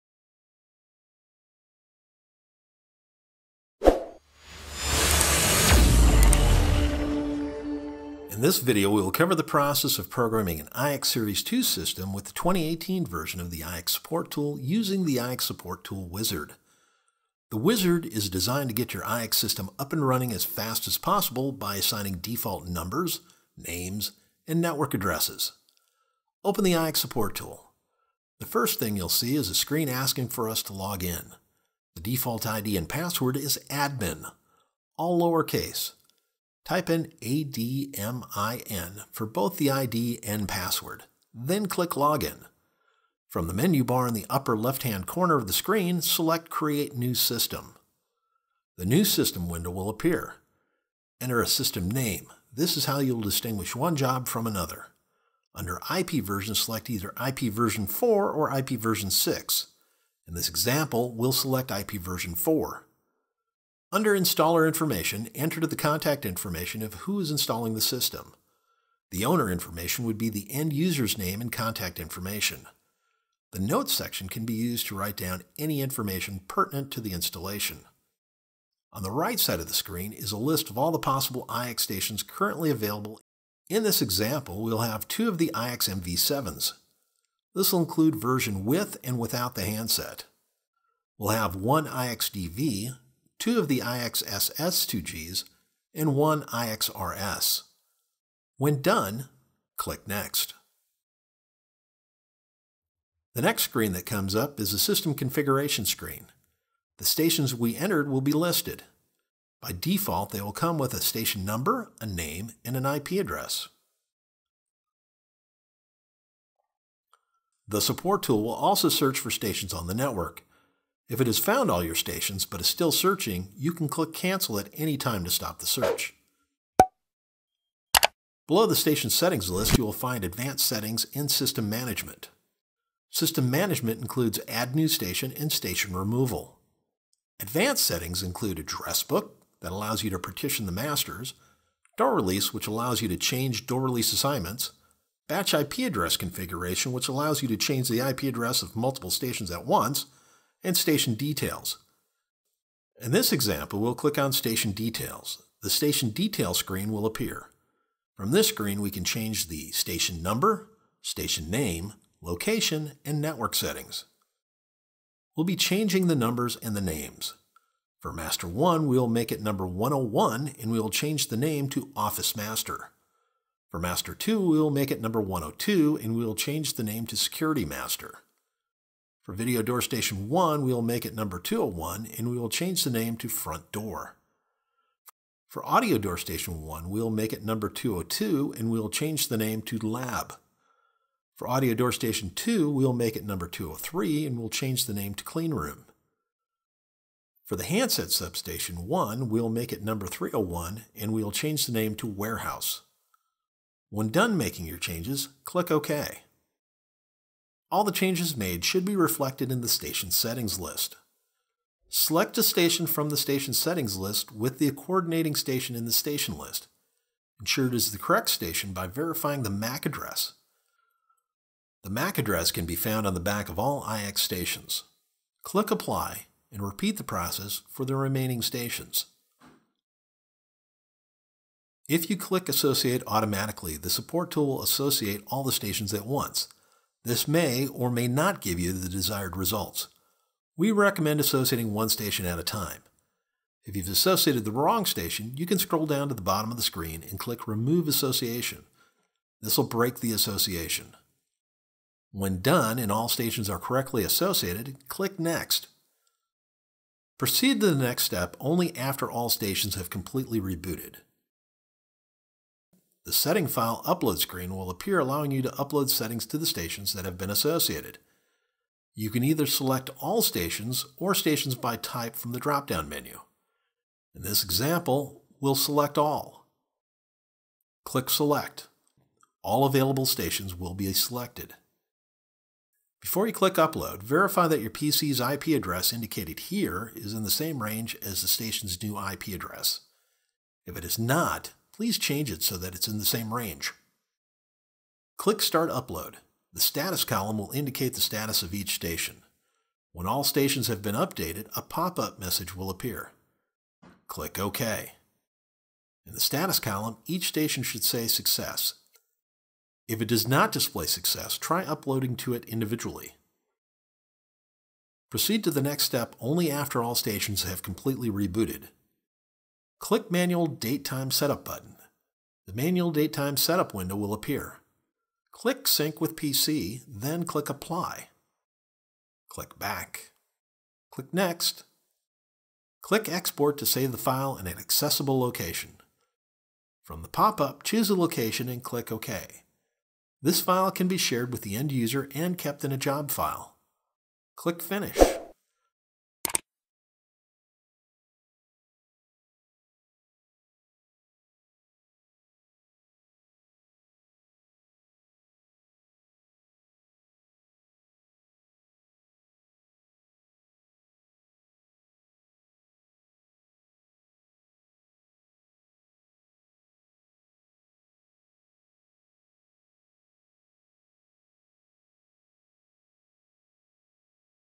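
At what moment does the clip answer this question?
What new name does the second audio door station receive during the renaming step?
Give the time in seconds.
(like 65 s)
195 s.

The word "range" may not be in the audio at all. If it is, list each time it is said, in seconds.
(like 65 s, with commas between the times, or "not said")
287 s, 293 s.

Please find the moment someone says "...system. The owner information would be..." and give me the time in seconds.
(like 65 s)
67 s.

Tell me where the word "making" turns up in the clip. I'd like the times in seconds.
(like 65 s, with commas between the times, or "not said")
204 s.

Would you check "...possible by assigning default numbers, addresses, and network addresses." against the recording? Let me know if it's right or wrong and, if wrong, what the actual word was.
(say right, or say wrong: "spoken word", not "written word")
wrong: "names", not "addresses".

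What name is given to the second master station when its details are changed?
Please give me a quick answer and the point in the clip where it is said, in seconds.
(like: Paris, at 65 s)
Security Master, at 177 s.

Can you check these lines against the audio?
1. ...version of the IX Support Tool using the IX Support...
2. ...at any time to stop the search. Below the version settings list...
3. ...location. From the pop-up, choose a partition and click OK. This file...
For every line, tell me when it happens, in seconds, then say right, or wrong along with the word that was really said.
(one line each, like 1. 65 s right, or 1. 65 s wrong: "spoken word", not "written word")
1. 13 s right
2. 124 s wrong: "station", not "version"
3. 335 s wrong: "location", not "partition".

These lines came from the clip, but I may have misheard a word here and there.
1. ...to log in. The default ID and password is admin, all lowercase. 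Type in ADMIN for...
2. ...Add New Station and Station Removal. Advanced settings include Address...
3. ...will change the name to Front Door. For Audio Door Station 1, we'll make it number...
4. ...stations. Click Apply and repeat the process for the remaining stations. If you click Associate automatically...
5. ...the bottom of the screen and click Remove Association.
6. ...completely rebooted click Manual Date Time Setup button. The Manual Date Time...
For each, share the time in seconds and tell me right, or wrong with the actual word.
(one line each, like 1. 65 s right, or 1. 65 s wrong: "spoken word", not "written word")
1. 30 s right
2. 134 s right
3. 182 s right
4. 224 s right
5. 246 s right
6. 317 s right.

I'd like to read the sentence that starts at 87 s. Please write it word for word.
This will include version with and without the handset.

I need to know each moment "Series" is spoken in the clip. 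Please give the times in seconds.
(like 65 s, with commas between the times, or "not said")
11 s.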